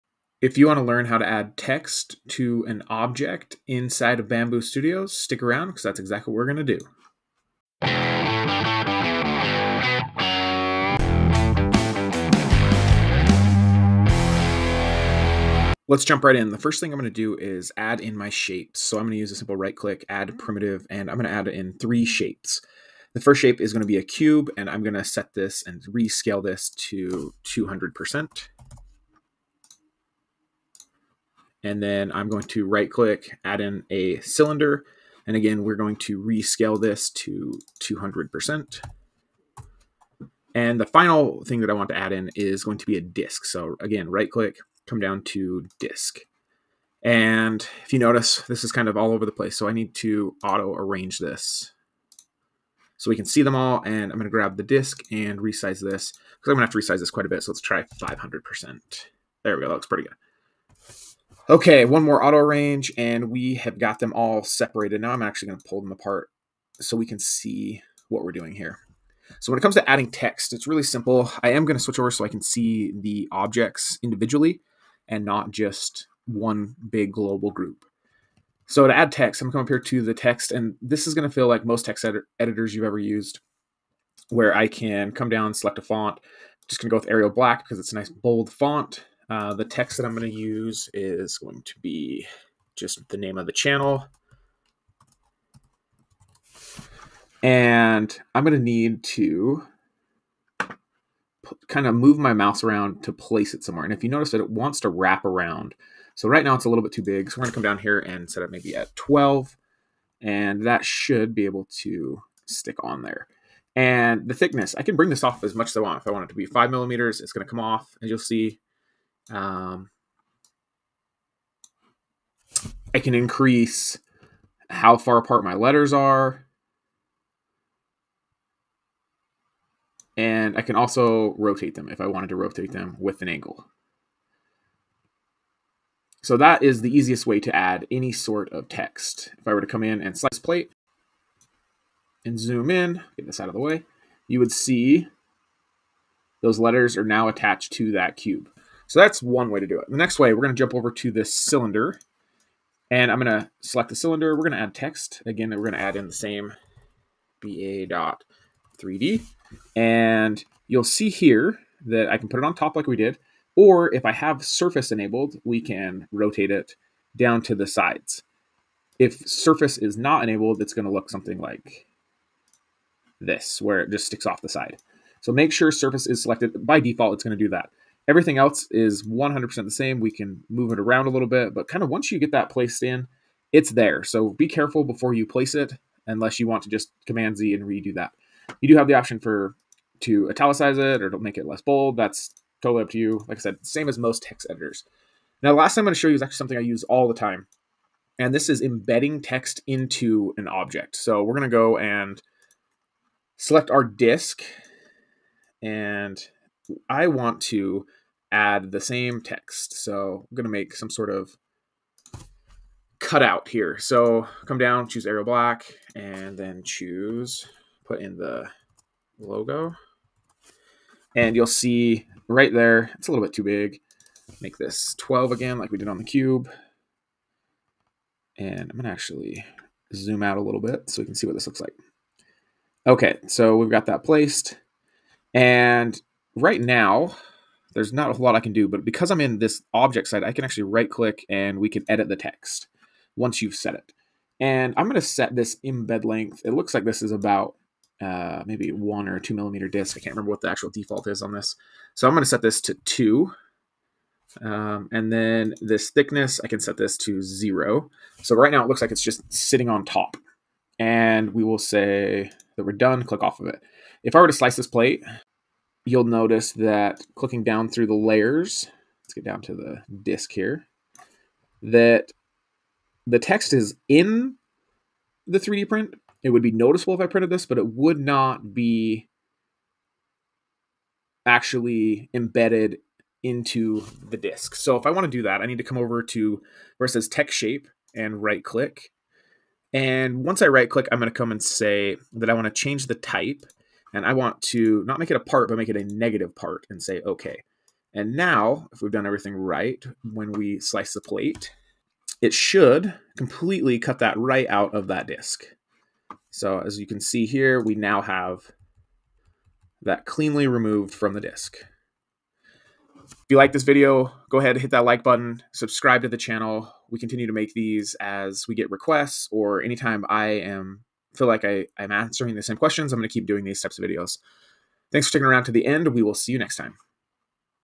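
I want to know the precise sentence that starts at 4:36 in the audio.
It would be noticeable if I printed this, but it would not be actually embedded into the disk.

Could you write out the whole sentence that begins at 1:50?
And that should be able to stick on there.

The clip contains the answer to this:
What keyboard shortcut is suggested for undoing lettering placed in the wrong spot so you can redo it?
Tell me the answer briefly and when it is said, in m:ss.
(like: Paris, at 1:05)
Command Z, at 3:07.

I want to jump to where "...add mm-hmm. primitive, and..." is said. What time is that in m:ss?
0:20.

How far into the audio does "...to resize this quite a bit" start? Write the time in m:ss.
0:56.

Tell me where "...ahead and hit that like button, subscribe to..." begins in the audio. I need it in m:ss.
5:14.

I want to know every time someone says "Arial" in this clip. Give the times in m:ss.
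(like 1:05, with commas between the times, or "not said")
1:27, 3:35.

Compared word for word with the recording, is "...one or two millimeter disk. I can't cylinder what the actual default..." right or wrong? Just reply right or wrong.
wrong.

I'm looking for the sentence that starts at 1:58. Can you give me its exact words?
as you'll see um, I can increase how far apart my letters are.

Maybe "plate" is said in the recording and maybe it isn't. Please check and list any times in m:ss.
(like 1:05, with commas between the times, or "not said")
2:20, 4:24, 5:01.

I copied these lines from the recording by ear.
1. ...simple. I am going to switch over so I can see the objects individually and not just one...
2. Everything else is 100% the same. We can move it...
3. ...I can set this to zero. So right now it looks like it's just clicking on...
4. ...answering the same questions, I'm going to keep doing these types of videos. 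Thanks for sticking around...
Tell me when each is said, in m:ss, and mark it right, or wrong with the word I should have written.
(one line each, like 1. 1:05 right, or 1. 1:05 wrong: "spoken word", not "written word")
1. 1:10 right
2. 2:58 right
3. 4:16 wrong: "sitting", not "clicking"
4. 5:21 right.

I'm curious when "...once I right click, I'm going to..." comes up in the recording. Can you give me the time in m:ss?
4:50.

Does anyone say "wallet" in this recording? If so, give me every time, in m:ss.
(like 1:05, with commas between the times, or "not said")
not said.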